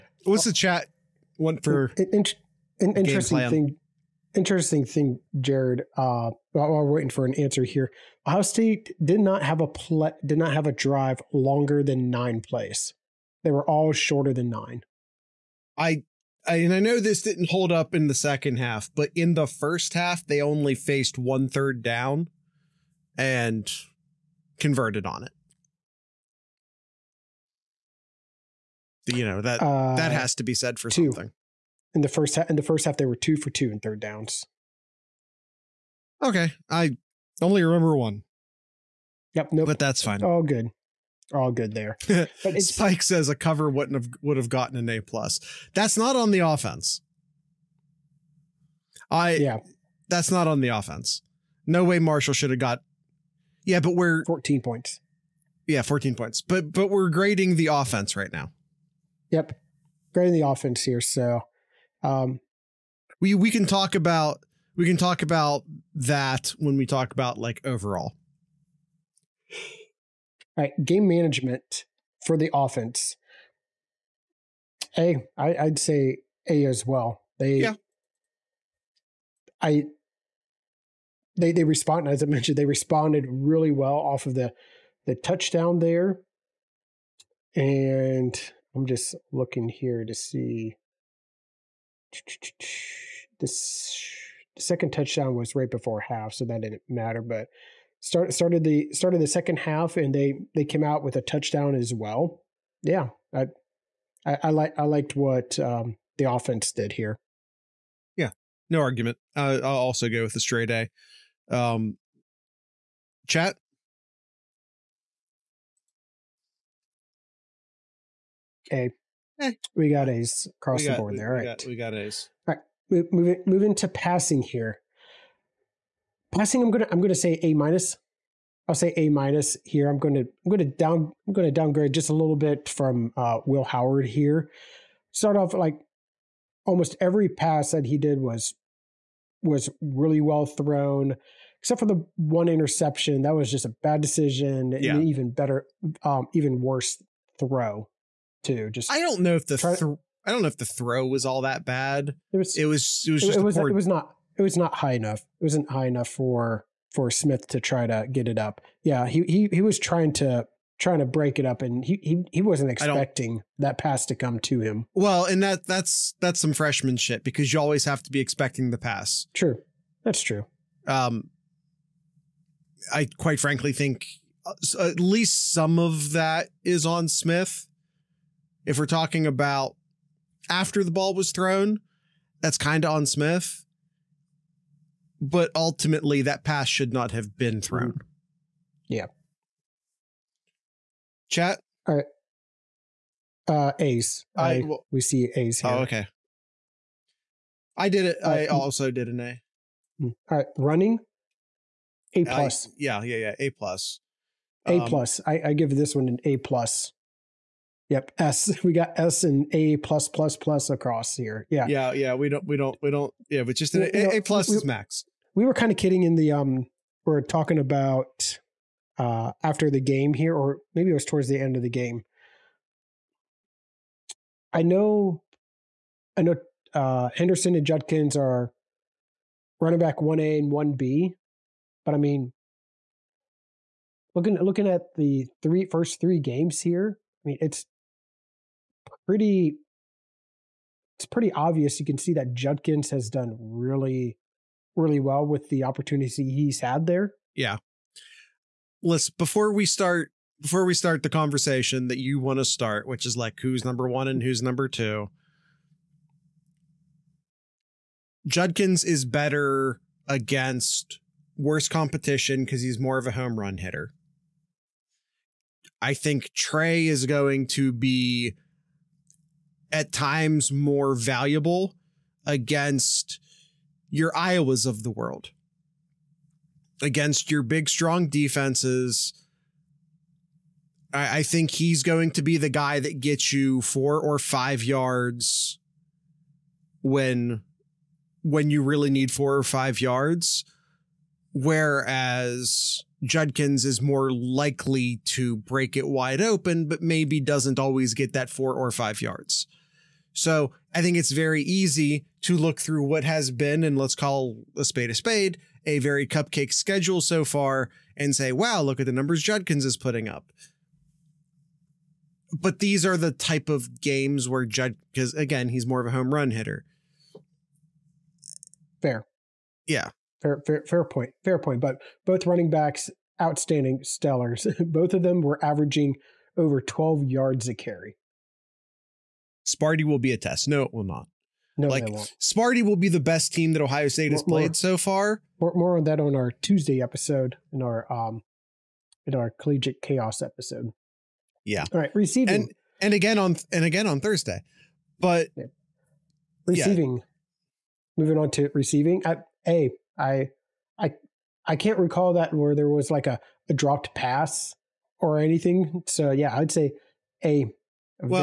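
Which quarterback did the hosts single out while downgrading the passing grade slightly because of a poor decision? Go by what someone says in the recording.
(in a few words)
Will Howard.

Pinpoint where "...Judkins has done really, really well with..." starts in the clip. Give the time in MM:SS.
04:02.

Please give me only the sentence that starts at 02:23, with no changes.
That was just a bad decision yeah.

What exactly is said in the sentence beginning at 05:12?
But these are the type of games where Jud, because again, he's more of a home run hitter.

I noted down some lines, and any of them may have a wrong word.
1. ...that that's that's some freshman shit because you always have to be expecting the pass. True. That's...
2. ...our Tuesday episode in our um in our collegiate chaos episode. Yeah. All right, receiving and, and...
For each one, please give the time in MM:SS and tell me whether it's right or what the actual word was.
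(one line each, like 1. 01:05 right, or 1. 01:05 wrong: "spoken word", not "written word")
1. 02:45 right
2. 05:36 right.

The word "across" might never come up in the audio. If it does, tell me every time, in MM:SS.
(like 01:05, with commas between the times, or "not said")
02:00, 03:30.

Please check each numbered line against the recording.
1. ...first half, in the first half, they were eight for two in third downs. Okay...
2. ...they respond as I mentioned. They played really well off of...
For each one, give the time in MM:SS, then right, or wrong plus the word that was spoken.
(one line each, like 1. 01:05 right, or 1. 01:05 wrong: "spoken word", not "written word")
1. 00:32 wrong: "two", not "eight"
2. 01:21 wrong: "responded", not "played".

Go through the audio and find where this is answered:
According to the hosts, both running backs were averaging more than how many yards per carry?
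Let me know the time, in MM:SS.
05:26.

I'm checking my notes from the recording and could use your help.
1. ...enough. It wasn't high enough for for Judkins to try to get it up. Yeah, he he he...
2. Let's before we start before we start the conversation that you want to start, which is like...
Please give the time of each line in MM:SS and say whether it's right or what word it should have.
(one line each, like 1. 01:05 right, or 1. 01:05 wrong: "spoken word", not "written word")
1. 02:34 wrong: "Smith", not "Judkins"
2. 04:08 right.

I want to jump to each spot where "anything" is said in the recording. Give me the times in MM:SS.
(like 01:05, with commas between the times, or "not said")
05:55.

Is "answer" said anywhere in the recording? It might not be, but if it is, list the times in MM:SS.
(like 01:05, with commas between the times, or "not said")
00:07.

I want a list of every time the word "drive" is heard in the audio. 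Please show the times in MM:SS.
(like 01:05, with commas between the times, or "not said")
00:10.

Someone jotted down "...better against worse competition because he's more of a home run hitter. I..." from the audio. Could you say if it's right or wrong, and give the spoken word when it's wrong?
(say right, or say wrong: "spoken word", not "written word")
right.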